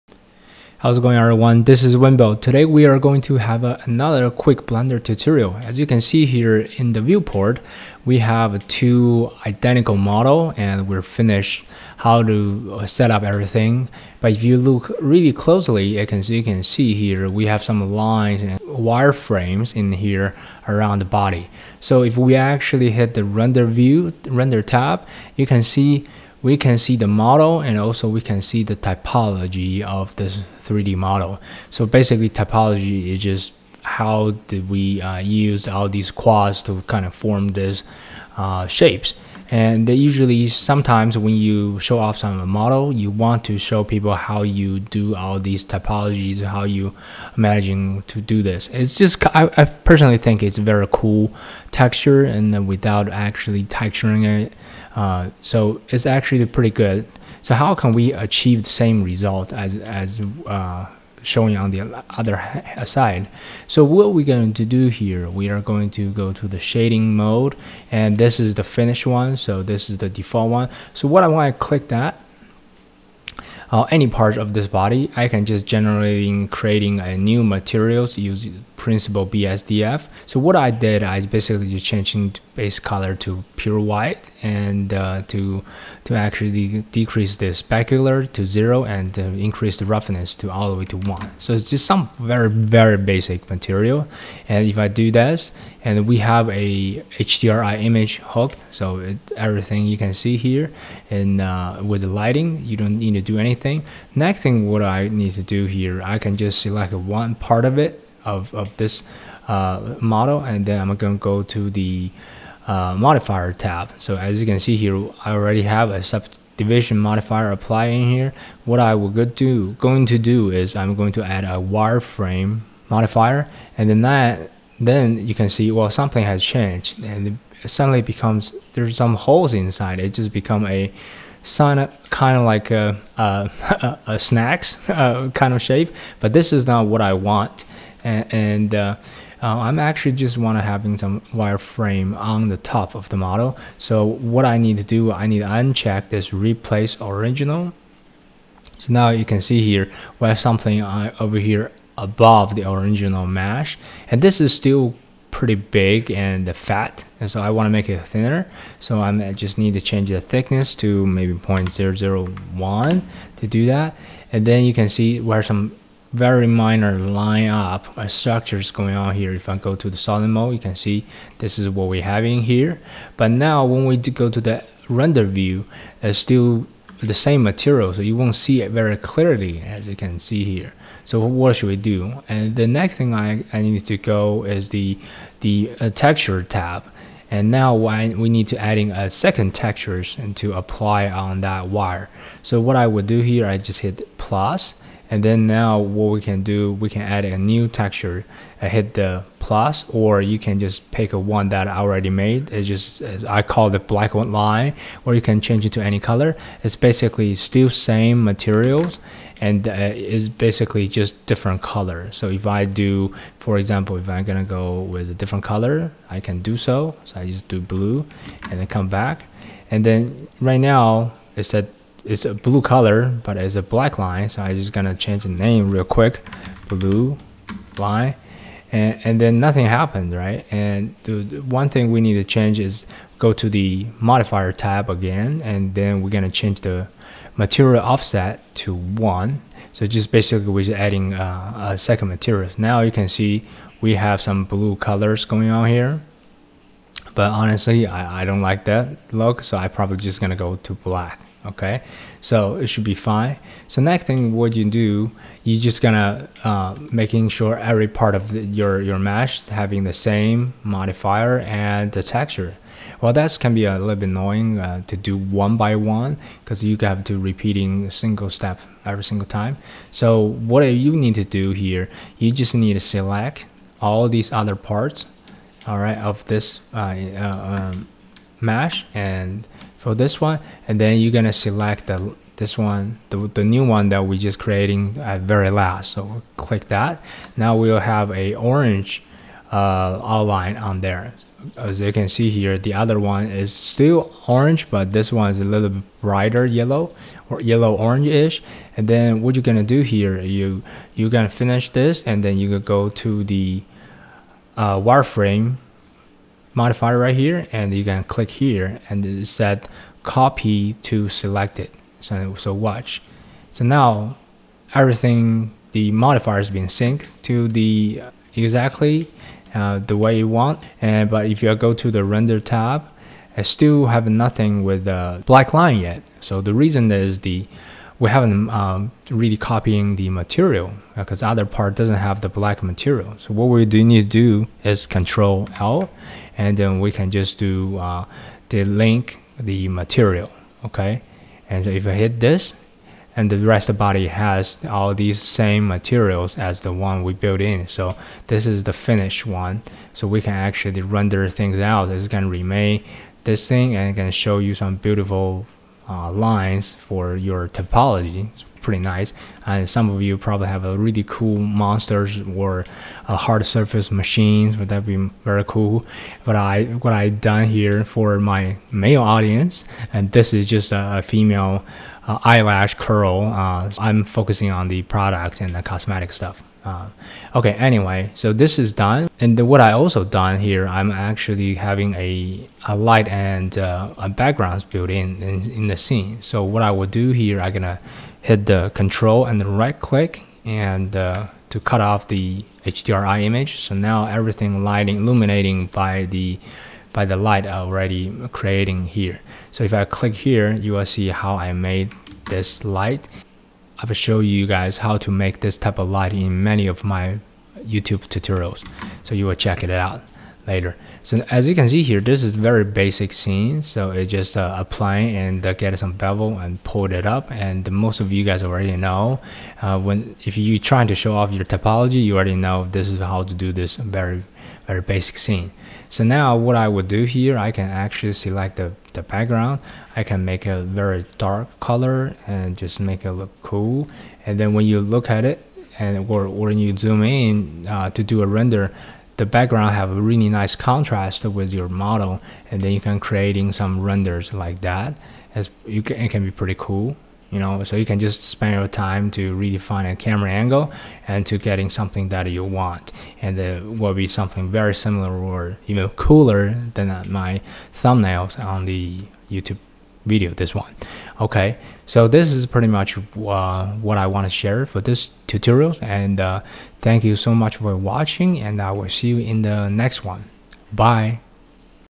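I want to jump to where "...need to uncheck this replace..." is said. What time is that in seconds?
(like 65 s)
145 s.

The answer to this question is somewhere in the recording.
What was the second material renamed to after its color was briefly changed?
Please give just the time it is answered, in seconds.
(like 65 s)
226 s.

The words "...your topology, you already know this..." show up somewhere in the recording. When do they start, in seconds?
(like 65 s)
421 s.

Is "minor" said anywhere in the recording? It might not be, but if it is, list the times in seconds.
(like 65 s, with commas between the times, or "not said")
166 s.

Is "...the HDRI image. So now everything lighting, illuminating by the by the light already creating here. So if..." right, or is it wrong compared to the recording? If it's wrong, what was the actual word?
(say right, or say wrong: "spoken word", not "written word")
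right.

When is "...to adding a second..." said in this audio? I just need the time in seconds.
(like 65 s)
188 s.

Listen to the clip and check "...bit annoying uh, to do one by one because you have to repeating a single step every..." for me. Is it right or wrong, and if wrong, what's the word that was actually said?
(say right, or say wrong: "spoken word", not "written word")
right.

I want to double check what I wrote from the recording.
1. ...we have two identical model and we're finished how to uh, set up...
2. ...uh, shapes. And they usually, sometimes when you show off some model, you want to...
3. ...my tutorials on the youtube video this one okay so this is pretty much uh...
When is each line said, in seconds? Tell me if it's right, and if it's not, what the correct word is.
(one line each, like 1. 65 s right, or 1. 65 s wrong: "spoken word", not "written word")
1. 8 s right
2. 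38 s right
3. 457 s wrong: "thumbnails", not "tutorials".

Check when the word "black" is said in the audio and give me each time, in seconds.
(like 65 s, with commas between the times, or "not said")
203 s, 223 s, 250 s, 325 s, 332 s.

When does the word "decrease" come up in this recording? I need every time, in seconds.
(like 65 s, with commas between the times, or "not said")
86 s.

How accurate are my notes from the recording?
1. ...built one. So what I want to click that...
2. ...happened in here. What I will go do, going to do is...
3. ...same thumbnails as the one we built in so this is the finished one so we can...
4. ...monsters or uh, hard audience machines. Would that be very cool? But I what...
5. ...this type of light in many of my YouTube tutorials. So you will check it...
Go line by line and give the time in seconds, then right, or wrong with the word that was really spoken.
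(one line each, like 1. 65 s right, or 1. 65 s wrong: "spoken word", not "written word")
1. 70 s wrong: "default", not "built"
2. 117 s wrong: "applied", not "happened"
3. 345 s wrong: "materials", not "thumbnails"
4. 361 s wrong: "surface", not "audience"
5. 405 s right.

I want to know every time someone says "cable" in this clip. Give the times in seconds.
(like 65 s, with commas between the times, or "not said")
not said.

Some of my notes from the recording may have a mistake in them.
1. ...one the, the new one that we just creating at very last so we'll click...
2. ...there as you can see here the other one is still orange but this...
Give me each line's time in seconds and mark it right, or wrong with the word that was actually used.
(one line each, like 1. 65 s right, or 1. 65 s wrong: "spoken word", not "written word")
1. 282 s right
2. 290 s right.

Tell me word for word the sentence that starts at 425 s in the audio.
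So now what I would do here, I can actually select the, the background.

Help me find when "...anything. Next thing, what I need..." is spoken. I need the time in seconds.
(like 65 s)
103 s.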